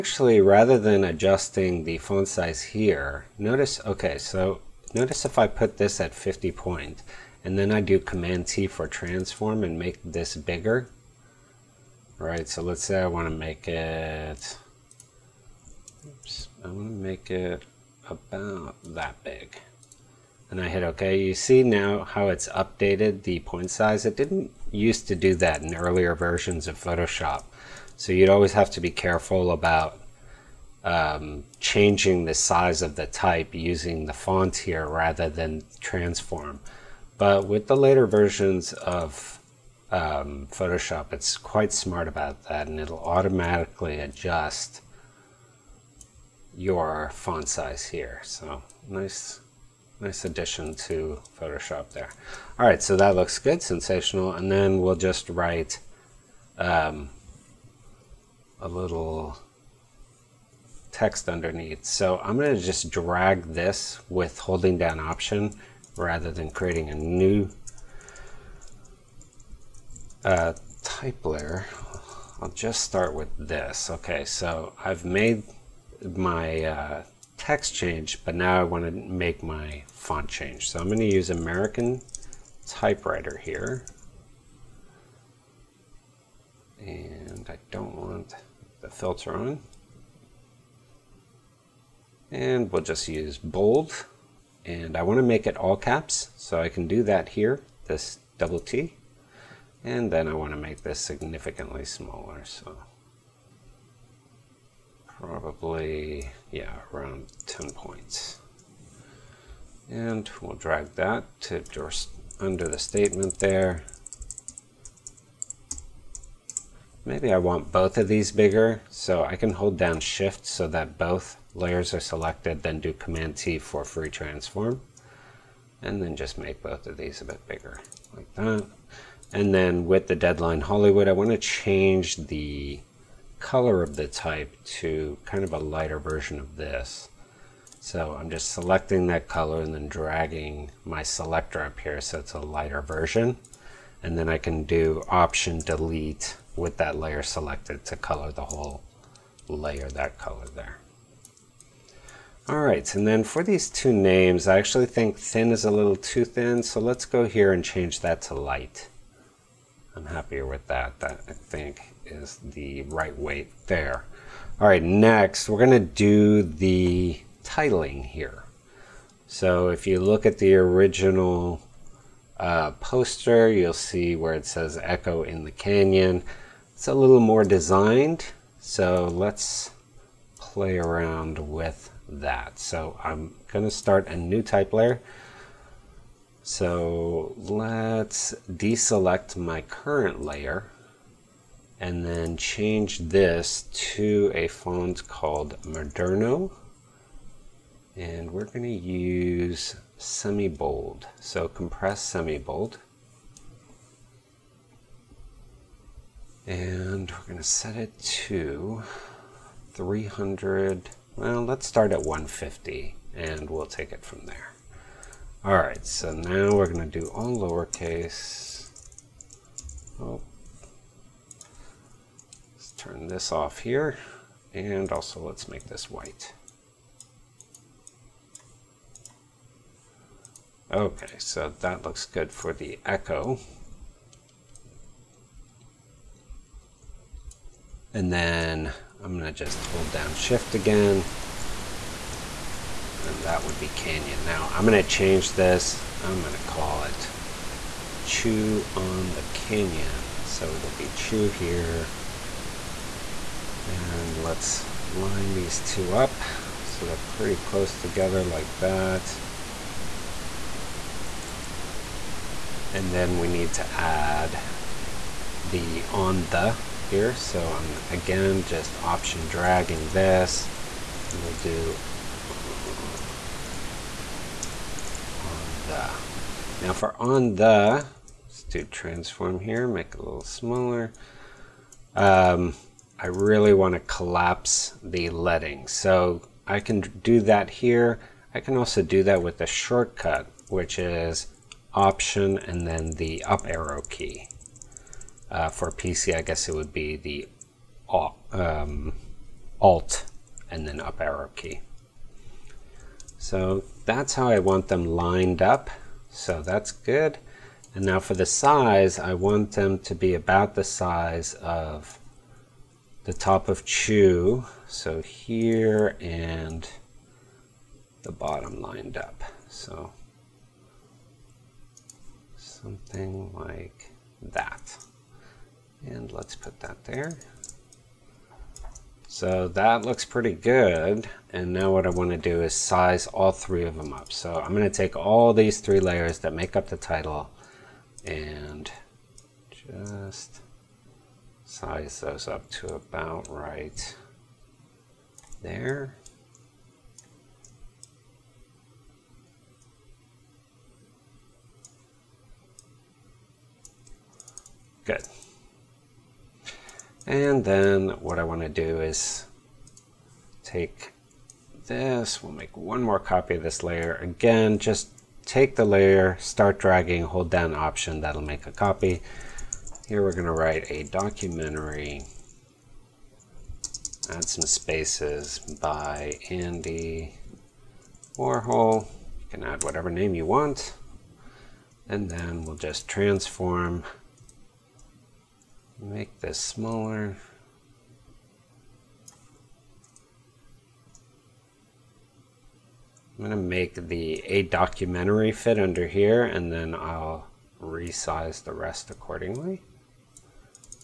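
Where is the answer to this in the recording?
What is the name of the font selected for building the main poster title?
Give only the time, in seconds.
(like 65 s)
195 s.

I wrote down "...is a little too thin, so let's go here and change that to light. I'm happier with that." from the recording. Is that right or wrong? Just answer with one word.
right.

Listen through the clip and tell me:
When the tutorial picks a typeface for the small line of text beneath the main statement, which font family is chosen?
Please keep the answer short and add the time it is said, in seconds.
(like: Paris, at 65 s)
American Typewriter, at 81 s.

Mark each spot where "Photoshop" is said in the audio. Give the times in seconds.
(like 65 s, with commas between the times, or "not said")
26 s, 40 s, 51 s.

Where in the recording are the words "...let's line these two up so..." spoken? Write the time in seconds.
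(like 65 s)
254 s.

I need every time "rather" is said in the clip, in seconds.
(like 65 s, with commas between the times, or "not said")
0 s, 34 s, 65 s.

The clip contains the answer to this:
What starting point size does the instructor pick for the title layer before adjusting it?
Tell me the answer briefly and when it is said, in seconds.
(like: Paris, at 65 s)
150, at 212 s.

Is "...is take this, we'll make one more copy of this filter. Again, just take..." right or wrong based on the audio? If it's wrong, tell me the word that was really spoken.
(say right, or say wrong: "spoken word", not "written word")
wrong: "layer", not "filter".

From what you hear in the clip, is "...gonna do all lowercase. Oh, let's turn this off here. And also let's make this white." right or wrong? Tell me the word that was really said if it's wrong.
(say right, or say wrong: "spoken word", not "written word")
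right.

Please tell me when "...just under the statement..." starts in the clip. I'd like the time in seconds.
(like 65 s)
111 s.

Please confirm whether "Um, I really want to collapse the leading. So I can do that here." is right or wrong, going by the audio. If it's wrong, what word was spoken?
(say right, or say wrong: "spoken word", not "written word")
right.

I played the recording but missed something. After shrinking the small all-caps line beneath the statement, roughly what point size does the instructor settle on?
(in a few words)
10.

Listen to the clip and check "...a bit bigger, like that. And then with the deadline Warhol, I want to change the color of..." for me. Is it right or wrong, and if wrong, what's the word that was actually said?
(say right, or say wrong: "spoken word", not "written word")
wrong: "Hollywood", not "Warhol".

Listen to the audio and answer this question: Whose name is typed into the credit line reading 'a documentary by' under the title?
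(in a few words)
Andy Warhol.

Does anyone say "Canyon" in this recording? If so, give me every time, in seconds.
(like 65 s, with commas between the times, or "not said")
175 s, 243 s, 249 s.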